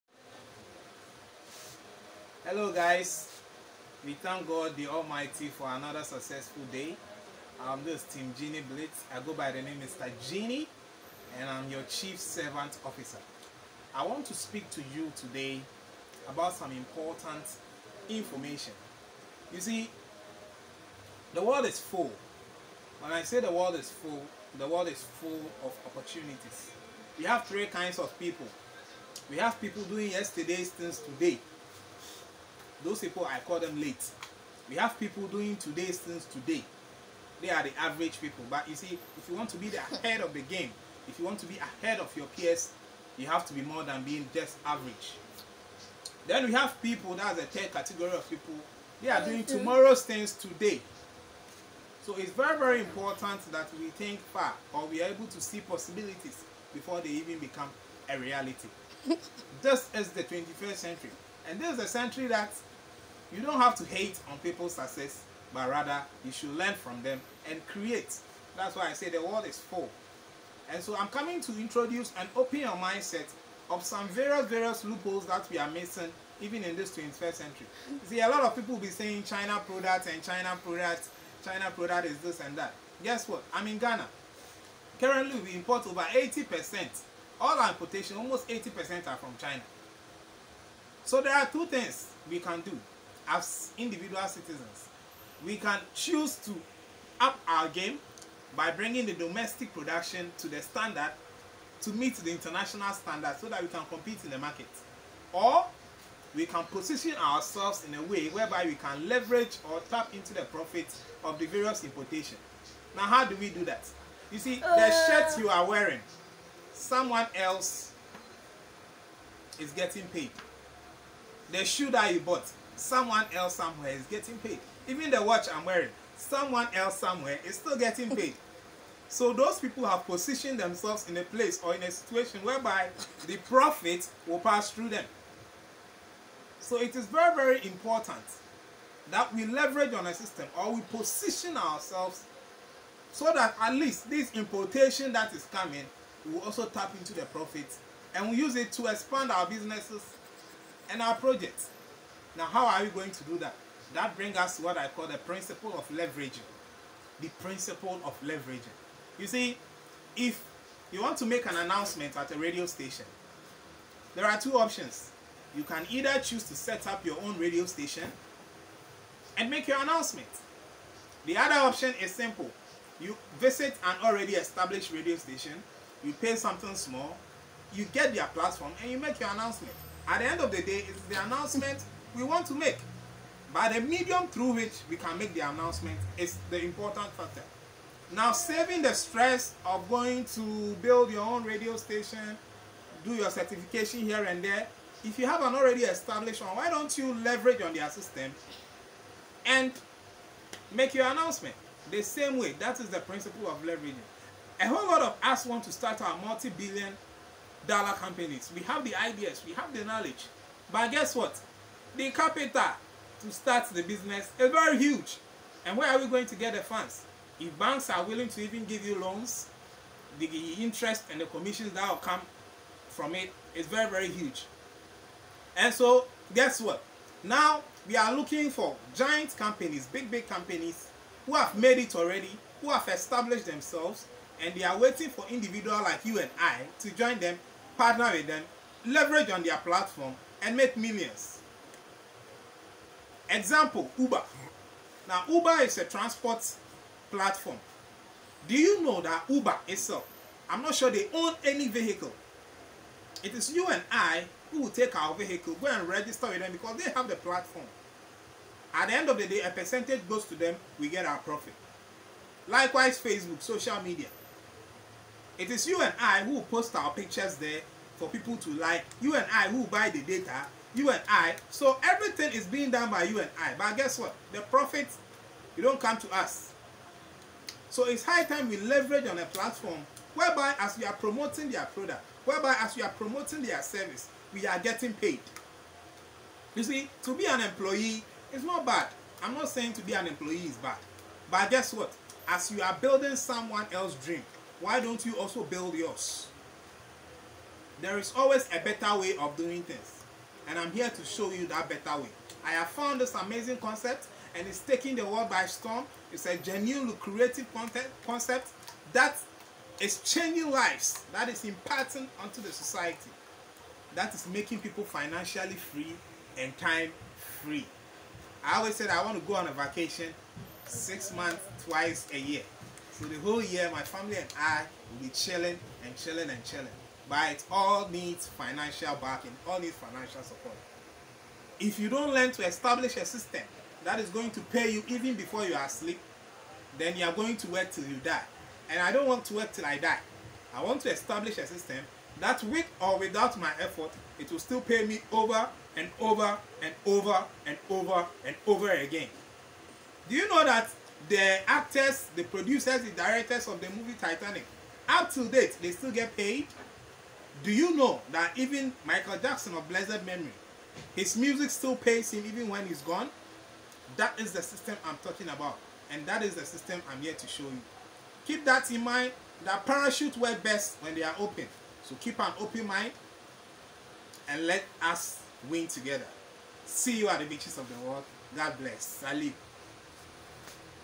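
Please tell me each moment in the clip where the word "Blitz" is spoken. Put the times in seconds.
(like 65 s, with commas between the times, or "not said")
8 s.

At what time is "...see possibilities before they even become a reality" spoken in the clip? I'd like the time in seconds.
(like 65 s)
55 s.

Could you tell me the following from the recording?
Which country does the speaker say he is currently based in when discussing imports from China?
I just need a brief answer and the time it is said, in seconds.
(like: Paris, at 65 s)
Ghana, at 83 s.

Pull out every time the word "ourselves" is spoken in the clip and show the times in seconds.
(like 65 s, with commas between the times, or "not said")
107 s, 141 s.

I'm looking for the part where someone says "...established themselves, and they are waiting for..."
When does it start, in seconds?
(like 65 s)
232 s.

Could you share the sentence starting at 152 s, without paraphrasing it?
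Now, how are you going to do that?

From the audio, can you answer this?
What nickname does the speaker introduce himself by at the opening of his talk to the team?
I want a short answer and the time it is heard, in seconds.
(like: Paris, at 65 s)
Mr. Genie, at 9 s.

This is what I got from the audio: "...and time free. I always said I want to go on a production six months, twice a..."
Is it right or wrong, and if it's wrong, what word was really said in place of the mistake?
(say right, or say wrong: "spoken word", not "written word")
wrong: "vacation", not "production".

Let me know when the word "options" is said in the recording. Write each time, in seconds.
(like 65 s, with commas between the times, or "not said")
164 s, 171 s.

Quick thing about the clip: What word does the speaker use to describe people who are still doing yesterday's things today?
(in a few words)
late.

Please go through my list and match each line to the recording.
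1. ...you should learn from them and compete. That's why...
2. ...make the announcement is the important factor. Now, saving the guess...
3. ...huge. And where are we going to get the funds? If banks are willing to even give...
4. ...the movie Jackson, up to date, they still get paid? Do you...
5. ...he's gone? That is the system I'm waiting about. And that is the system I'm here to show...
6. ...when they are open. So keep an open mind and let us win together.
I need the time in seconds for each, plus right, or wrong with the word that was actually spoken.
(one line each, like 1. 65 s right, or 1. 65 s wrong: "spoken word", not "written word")
1. 66 s wrong: "create", not "compete"
2. 185 s wrong: "stress", not "guess"
3. 214 s right
4. 353 s wrong: "Titanic", not "Jackson"
5. 362 s wrong: "talking", not "waiting"
6. 370 s right.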